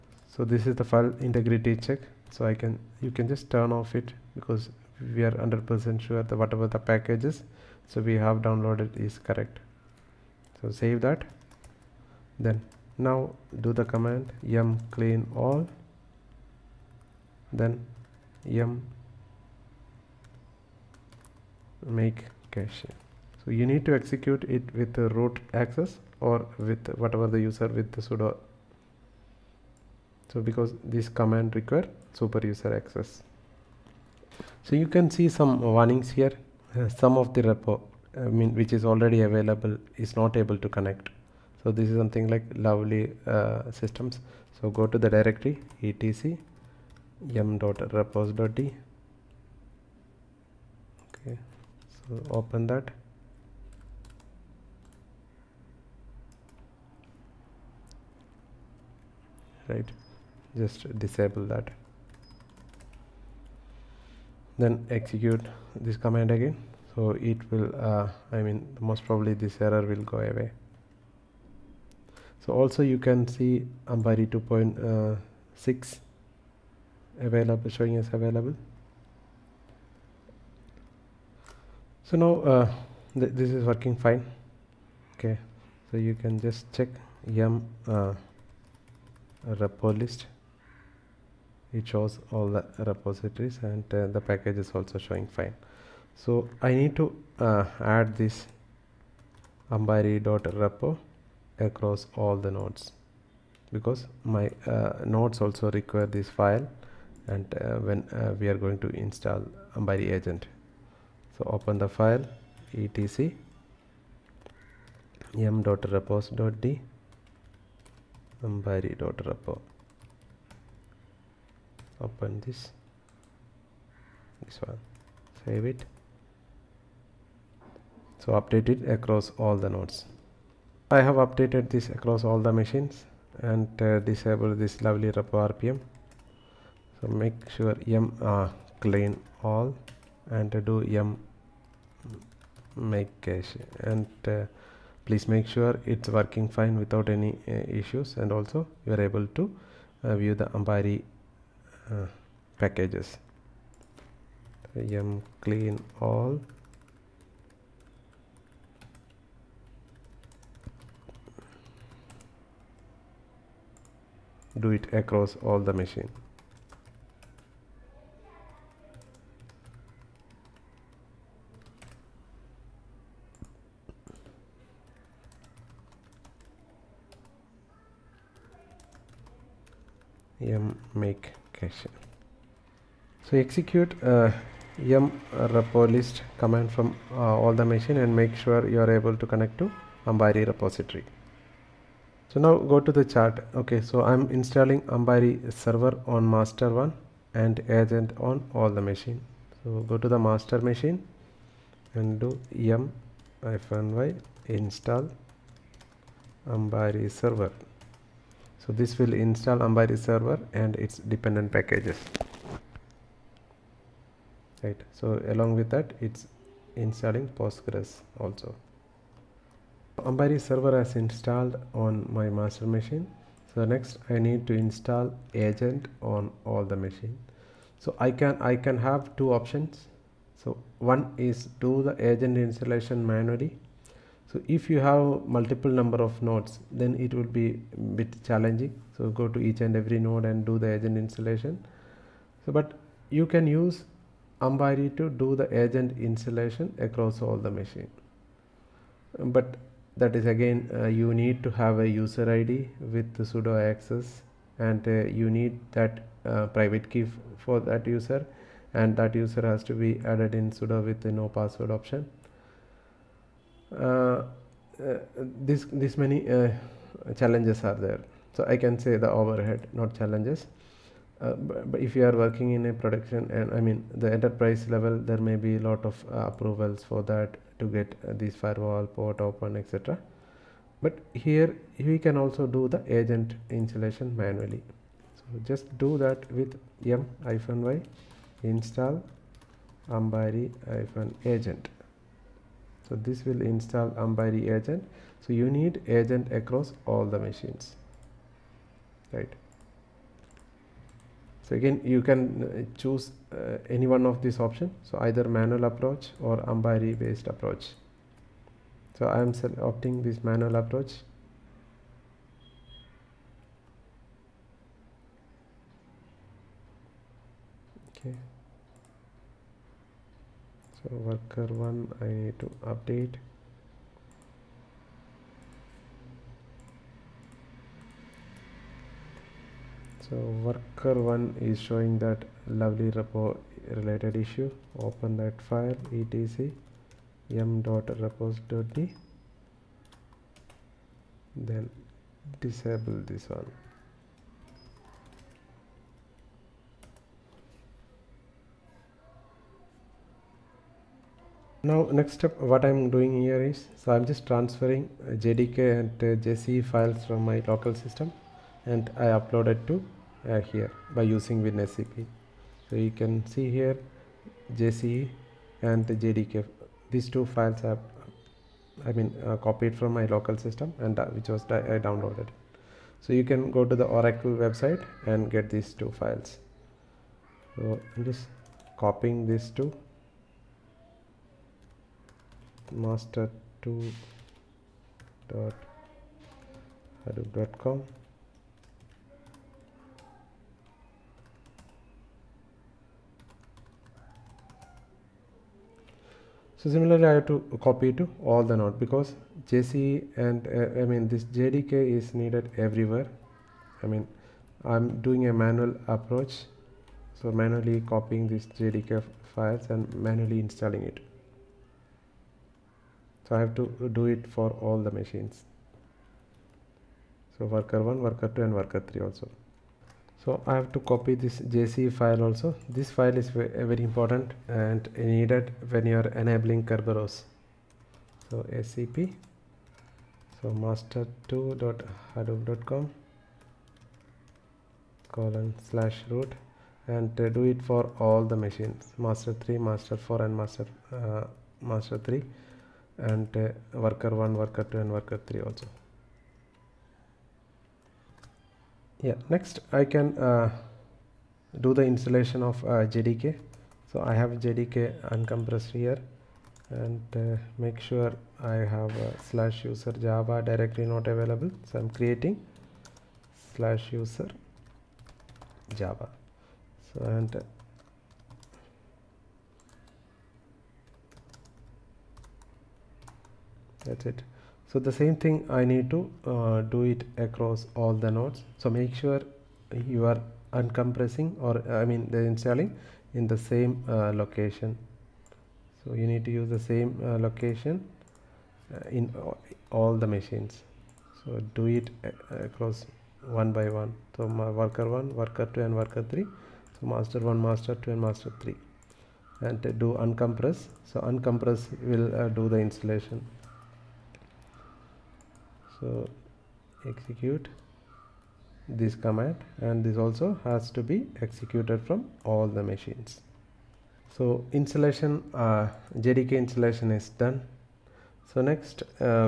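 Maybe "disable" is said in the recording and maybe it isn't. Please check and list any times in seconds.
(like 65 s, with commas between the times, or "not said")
60 s, 133 s, 342 s.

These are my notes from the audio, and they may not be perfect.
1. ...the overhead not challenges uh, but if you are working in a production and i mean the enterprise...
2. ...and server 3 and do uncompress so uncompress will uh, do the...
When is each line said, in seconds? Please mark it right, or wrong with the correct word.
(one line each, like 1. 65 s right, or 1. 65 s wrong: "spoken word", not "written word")
1. 268 s right
2. 497 s wrong: "master", not "server".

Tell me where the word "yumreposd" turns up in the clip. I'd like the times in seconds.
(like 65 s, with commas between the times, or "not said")
47 s, 115 s.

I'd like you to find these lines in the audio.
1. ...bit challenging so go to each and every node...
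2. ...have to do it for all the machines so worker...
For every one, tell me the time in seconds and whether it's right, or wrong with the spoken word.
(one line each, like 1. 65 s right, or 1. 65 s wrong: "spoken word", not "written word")
1. 237 s right
2. 413 s right.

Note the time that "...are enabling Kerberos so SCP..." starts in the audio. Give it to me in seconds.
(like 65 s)
425 s.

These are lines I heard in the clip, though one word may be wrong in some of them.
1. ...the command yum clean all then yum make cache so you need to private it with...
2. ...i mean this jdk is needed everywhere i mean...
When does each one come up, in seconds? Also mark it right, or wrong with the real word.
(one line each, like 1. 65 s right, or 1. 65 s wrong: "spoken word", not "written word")
1. 13 s wrong: "execute", not "private"
2. 400 s right.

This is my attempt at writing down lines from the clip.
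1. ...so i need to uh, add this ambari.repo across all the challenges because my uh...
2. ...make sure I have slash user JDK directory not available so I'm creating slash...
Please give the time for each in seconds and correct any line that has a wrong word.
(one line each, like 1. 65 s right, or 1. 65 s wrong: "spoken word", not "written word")
1. 96 s wrong: "nodes", not "challenges"
2. 457 s wrong: "Java", not "JDK".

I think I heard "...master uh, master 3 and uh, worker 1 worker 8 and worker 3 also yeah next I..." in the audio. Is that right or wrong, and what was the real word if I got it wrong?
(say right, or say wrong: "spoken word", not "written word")
wrong: "2", not "8".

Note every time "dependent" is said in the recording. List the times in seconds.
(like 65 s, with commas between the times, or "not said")
211 s.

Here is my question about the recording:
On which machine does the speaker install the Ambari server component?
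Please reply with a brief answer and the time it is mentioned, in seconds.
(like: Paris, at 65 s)
master one, at 196 s.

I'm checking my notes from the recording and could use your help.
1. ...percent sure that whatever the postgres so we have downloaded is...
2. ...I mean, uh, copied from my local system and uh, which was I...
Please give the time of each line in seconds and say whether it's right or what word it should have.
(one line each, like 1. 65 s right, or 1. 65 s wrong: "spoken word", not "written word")
1. 5 s wrong: "packages", not "postgres"
2. 368 s right.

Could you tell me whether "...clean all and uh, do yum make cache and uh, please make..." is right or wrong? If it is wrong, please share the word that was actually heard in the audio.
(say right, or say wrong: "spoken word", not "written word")
right.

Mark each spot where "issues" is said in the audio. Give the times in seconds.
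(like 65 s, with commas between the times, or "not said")
147 s, 334 s.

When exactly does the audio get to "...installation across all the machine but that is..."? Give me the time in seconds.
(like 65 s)
245 s.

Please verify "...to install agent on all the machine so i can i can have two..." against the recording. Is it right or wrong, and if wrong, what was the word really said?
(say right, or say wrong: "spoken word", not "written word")
right.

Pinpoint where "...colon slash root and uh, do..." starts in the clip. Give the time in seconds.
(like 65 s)
435 s.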